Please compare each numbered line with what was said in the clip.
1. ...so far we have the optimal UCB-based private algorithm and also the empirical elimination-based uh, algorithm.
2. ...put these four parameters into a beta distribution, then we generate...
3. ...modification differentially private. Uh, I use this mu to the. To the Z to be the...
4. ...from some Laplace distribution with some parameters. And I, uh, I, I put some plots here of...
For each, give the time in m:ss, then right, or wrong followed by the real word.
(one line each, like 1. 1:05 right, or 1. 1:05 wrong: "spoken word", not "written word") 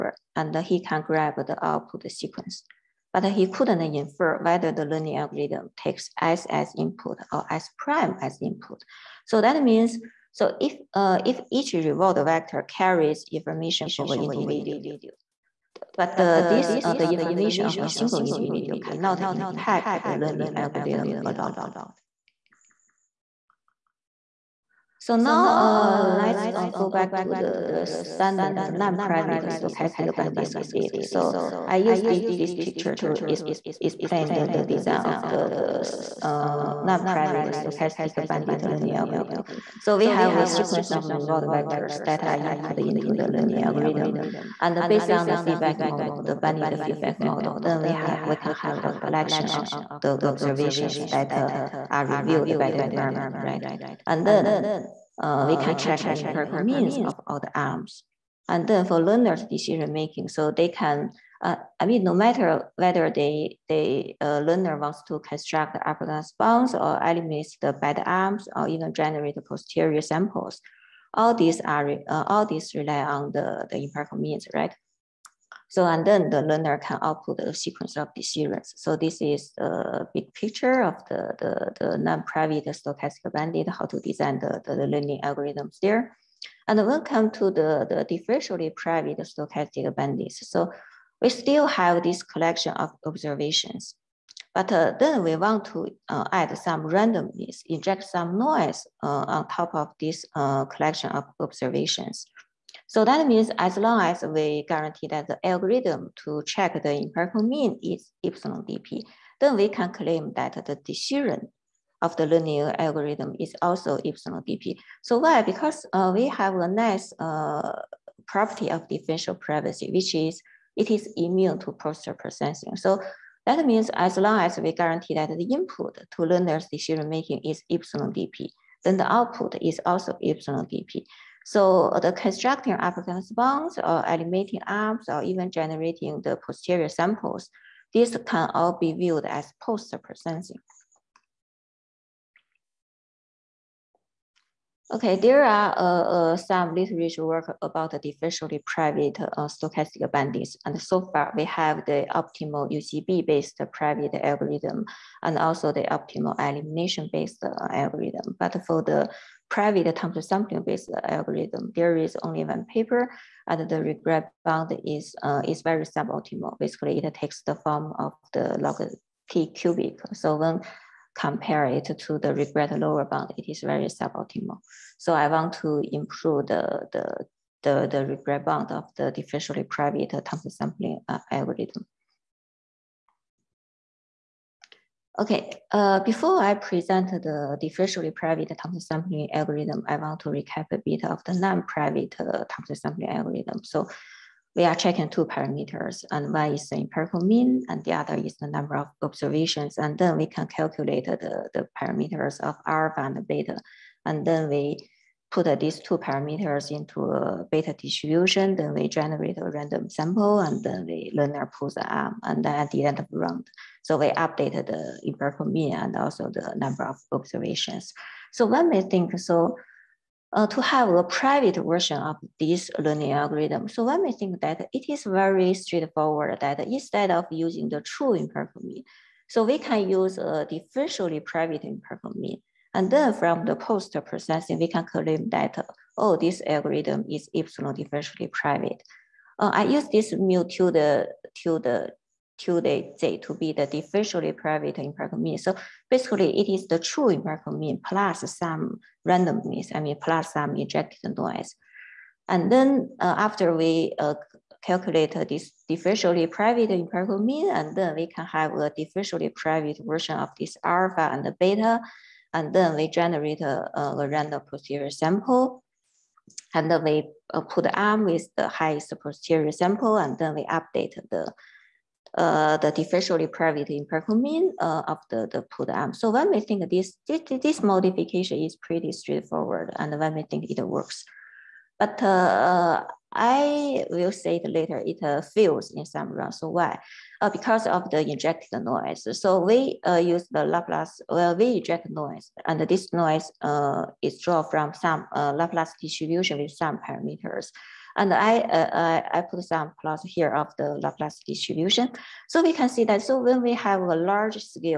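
1. 2:30 wrong: "optimal", not "empirical"
2. 3:25 wrong: "two", not "four"
3. 3:57 wrong: "epsilon", not "modification"
4. 4:54 right.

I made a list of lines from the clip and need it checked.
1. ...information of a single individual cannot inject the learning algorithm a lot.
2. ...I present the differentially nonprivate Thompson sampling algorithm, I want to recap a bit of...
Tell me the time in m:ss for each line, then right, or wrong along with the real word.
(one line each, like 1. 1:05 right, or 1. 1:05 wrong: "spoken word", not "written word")
1. 0:17 wrong: "impact", not "inject"
2. 3:06 wrong: "private", not "nonprivate".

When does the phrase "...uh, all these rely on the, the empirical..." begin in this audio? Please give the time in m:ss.
1:12.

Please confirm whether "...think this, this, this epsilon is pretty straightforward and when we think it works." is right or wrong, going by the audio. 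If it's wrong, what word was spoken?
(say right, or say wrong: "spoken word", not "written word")
wrong: "modification", not "epsilon".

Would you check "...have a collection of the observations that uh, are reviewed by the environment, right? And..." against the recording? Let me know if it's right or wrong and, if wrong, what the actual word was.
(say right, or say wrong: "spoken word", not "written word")
right.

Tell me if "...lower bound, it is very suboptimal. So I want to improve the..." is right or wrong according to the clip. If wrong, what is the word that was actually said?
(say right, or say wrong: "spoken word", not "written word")
right.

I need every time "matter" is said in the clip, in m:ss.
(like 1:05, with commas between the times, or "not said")
1:02.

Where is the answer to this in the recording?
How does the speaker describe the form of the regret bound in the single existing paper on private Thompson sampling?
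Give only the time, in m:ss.
2:48.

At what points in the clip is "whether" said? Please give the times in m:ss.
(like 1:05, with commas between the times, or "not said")
0:04, 1:02.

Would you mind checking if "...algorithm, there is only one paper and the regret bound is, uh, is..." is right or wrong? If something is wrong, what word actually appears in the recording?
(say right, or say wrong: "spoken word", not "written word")
right.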